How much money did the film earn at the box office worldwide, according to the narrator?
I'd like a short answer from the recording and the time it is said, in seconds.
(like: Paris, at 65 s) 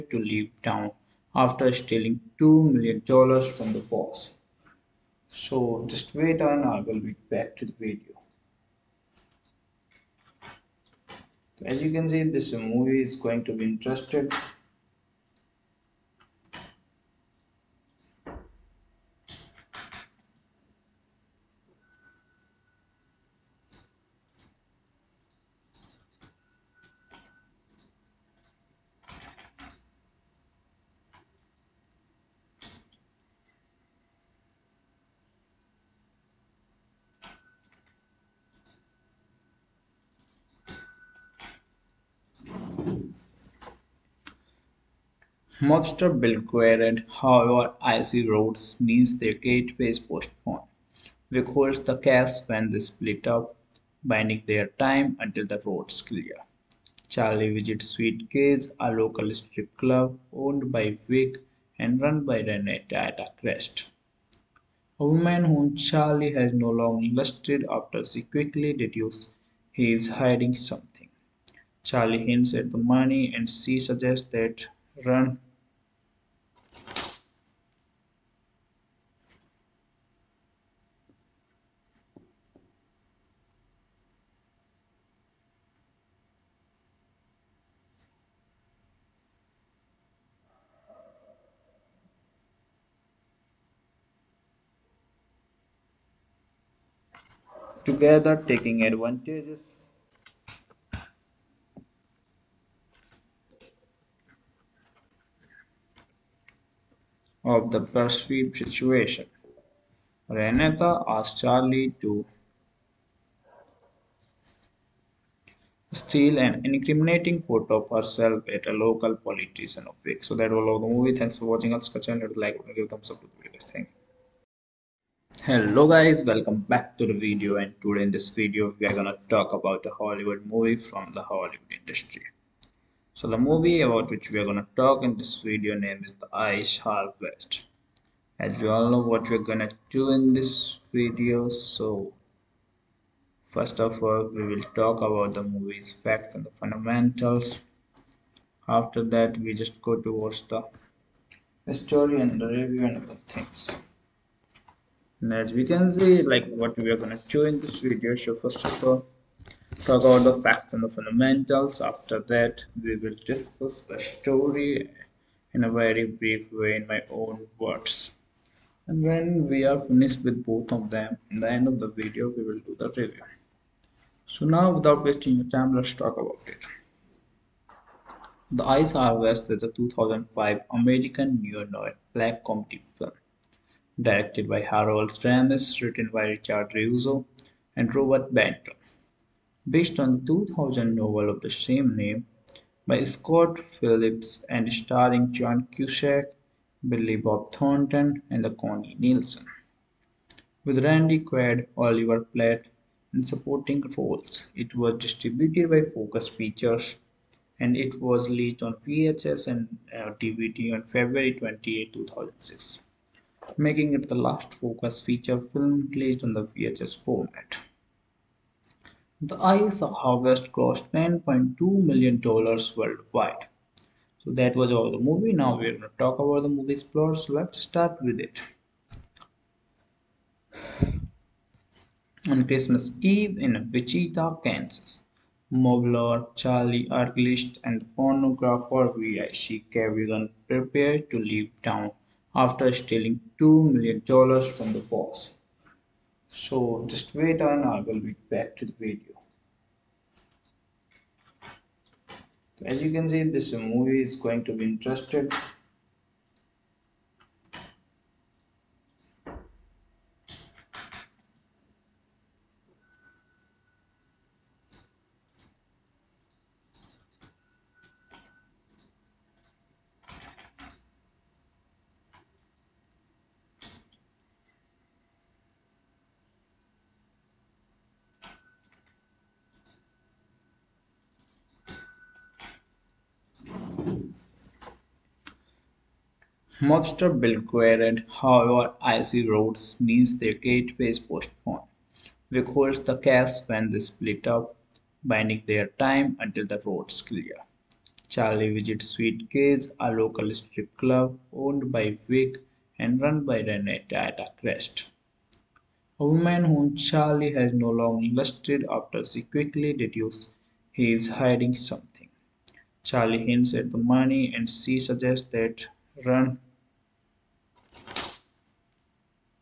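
$10.2 million, at 220 s.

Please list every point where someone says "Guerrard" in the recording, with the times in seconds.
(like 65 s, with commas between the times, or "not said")
46 s, 287 s.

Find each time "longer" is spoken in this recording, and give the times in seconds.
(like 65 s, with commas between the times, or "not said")
66 s, 307 s.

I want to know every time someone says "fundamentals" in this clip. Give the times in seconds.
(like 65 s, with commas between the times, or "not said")
146 s, 160 s.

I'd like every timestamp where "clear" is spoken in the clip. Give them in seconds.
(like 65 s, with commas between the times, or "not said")
56 s, 297 s.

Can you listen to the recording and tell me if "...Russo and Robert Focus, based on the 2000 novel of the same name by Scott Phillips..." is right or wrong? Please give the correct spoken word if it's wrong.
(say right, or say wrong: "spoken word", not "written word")
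wrong: "Benton", not "Focus".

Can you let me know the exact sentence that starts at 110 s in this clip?
Renata asked Charlie to steal an incriminating photo of herself at a local politician of week.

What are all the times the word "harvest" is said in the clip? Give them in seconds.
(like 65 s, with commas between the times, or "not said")
136 s, 179 s, 219 s.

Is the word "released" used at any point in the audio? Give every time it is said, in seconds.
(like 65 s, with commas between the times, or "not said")
208 s, 215 s.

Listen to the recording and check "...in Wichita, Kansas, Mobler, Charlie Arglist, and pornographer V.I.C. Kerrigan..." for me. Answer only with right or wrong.
right.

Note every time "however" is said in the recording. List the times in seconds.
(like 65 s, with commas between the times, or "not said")
47 s, 288 s.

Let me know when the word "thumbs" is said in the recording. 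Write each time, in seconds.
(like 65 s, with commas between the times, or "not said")
122 s.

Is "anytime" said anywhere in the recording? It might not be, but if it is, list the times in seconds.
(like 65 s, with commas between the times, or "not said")
not said.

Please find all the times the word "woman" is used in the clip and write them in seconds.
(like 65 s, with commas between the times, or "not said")
65 s, 306 s.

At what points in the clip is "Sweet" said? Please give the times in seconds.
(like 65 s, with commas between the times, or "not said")
57 s, 298 s.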